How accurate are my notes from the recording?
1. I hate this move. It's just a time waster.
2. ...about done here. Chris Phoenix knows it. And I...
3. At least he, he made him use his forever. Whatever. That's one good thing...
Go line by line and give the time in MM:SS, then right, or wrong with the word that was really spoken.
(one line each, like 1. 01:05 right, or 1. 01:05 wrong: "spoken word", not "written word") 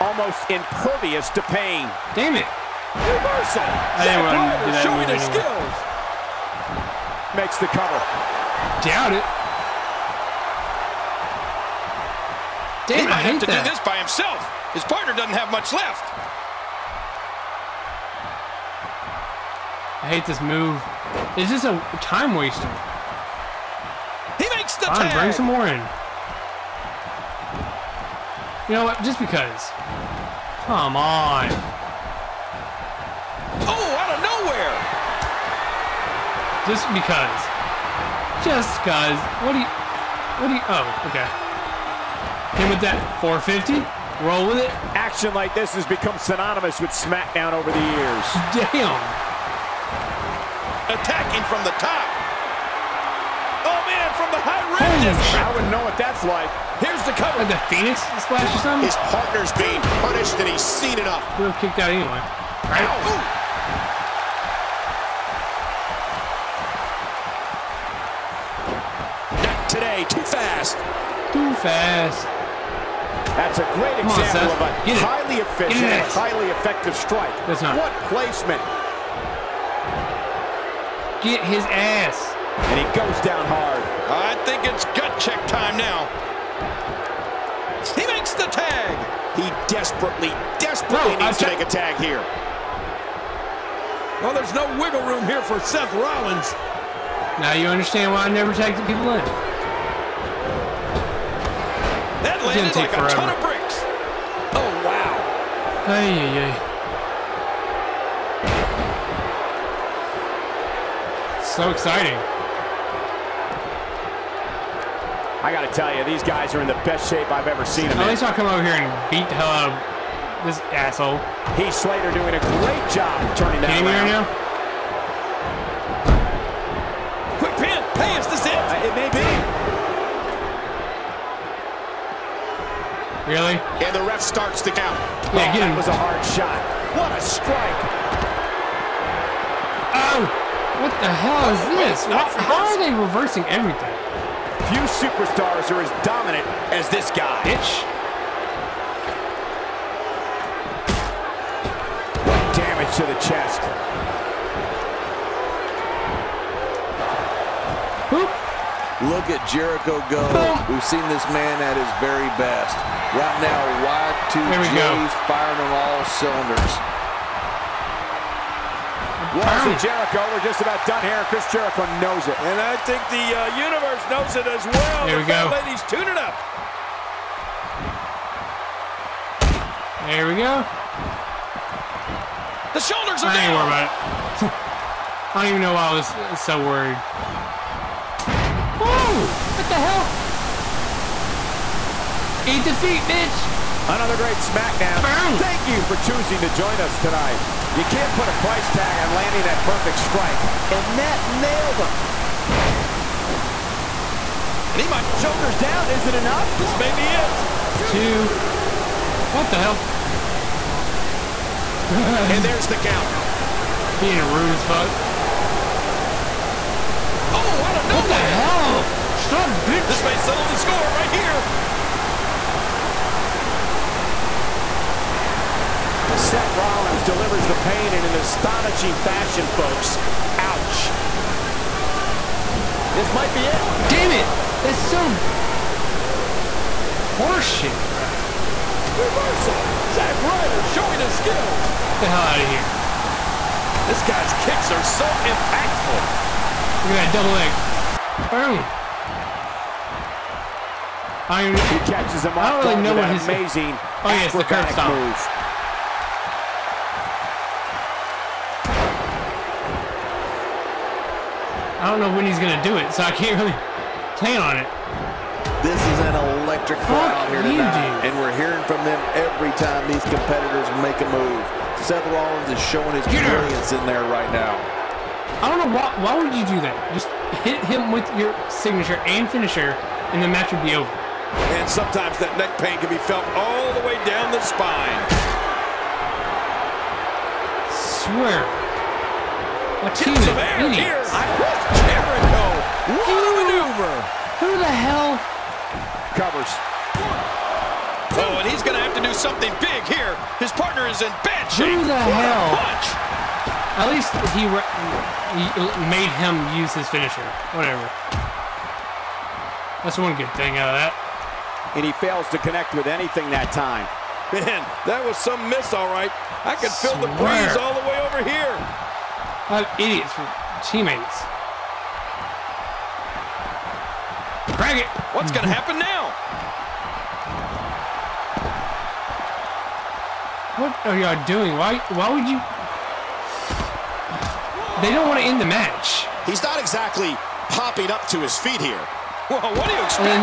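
1. 00:20 right
2. 02:50 wrong: "Jericho", not "Phoenix"
3. 05:03 wrong: "finisher", not "forever".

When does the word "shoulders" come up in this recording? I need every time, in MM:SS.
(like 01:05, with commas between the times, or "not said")
03:02, 03:25.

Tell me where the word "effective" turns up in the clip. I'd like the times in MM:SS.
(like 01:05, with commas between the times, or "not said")
01:16.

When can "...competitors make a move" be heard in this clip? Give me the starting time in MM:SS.
04:30.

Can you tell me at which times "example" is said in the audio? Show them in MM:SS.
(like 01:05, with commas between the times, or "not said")
01:14.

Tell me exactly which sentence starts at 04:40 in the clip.
And sometimes that neck pain can be felt all the way down the spine.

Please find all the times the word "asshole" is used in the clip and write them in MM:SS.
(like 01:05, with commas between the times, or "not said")
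02:00.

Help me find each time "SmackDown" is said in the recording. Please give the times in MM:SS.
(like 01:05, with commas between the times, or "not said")
00:46, 03:14.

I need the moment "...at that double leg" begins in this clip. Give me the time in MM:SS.
04:06.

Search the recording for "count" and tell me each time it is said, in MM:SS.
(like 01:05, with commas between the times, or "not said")
02:14, 03:32.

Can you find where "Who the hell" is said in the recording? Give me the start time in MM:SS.
04:54.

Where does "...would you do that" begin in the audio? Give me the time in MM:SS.
04:36.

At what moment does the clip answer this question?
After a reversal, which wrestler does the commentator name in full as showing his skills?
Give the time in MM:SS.
03:59.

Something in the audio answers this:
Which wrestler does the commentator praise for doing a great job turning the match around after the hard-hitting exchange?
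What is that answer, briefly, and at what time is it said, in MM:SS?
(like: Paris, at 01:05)
Slater, at 02:01.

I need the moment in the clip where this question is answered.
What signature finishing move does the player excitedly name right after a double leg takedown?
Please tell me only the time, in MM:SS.
04:14.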